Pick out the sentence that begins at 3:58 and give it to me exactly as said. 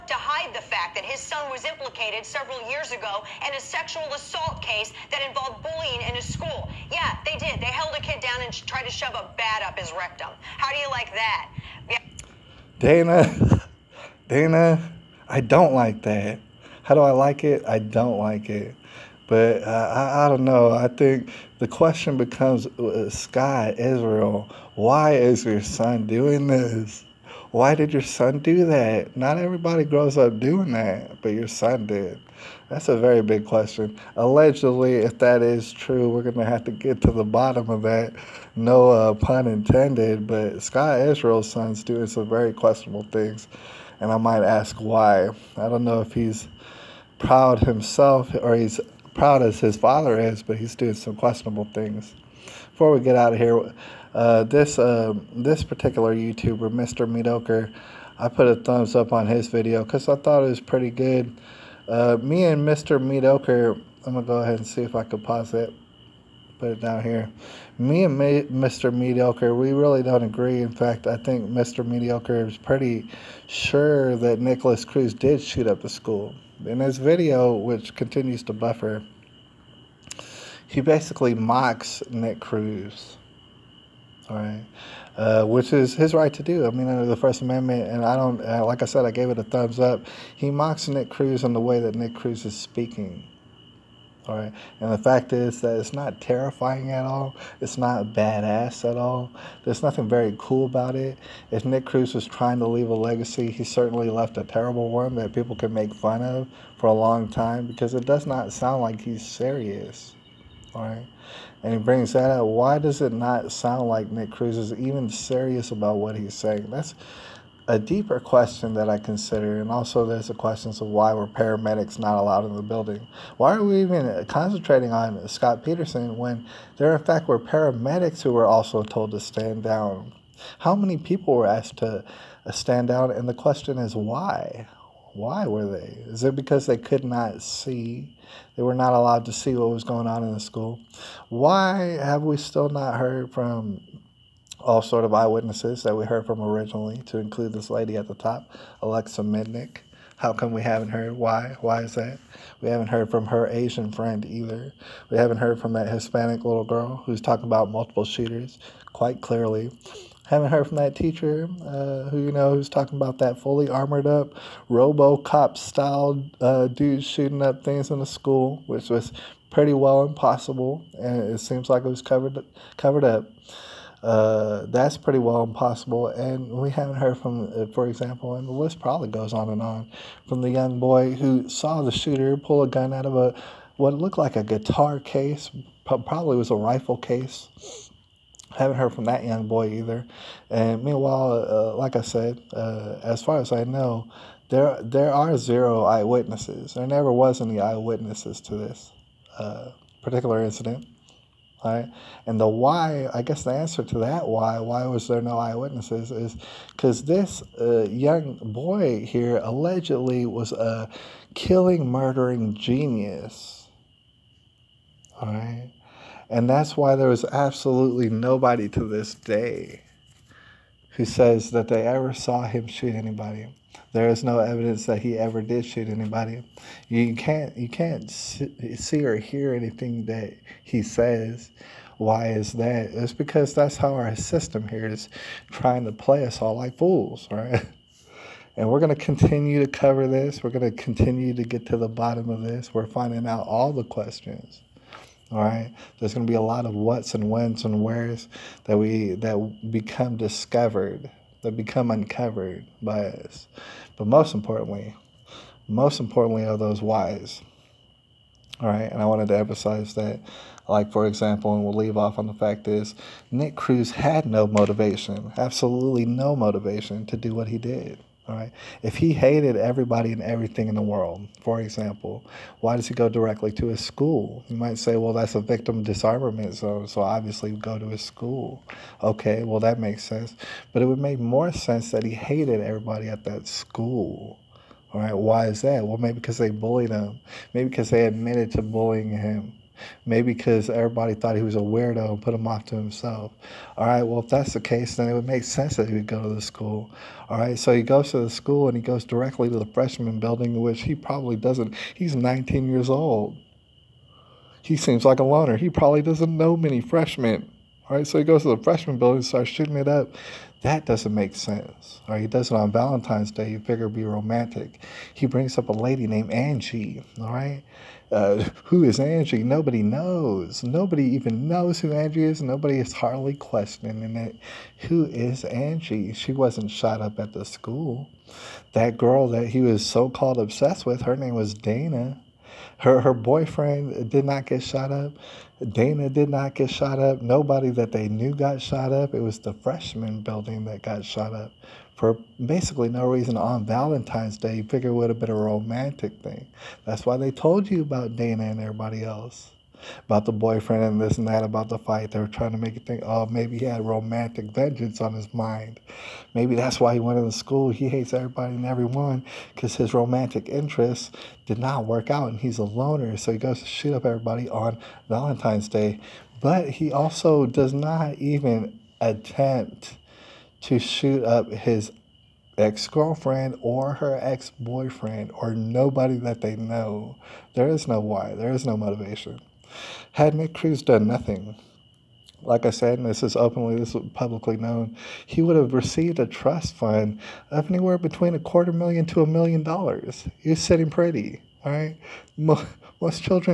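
And we're going to continue to cover this.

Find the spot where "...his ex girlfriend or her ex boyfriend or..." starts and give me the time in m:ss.
6:11.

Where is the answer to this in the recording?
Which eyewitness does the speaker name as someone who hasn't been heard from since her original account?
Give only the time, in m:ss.
2:28.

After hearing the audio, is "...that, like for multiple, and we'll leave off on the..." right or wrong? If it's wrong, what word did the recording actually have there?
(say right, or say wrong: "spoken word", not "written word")
wrong: "example", not "multiple".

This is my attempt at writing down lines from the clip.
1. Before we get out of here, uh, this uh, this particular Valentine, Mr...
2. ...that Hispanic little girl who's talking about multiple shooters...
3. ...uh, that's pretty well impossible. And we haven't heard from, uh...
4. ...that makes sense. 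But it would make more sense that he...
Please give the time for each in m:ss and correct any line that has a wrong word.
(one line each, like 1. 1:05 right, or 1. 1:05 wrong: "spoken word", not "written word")
1. 0:52 wrong: "YouTuber", not "Valentine"
2. 2:35 right
3. 2:54 right
4. 4:39 right.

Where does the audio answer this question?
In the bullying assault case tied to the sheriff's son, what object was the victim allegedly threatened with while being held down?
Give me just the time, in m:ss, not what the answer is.
0:09.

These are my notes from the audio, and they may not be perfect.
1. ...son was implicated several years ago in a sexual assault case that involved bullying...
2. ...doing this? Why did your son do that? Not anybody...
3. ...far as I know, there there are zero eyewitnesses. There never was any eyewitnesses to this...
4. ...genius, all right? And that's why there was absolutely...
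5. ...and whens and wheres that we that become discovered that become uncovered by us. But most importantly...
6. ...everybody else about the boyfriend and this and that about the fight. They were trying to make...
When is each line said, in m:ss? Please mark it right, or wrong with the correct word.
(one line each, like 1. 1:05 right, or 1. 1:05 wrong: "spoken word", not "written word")
1. 0:01 right
2. 0:26 wrong: "everybody", not "anybody"
3. 3:13 right
4. 3:32 right
5. 4:07 right
6. 5:48 right.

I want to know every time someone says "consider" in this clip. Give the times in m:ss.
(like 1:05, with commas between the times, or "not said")
1:58.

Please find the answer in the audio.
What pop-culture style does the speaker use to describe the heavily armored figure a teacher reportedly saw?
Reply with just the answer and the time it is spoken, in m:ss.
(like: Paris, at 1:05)
RoboCop style, at 2:44.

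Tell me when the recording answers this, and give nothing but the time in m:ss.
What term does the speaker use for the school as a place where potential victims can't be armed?
4:35.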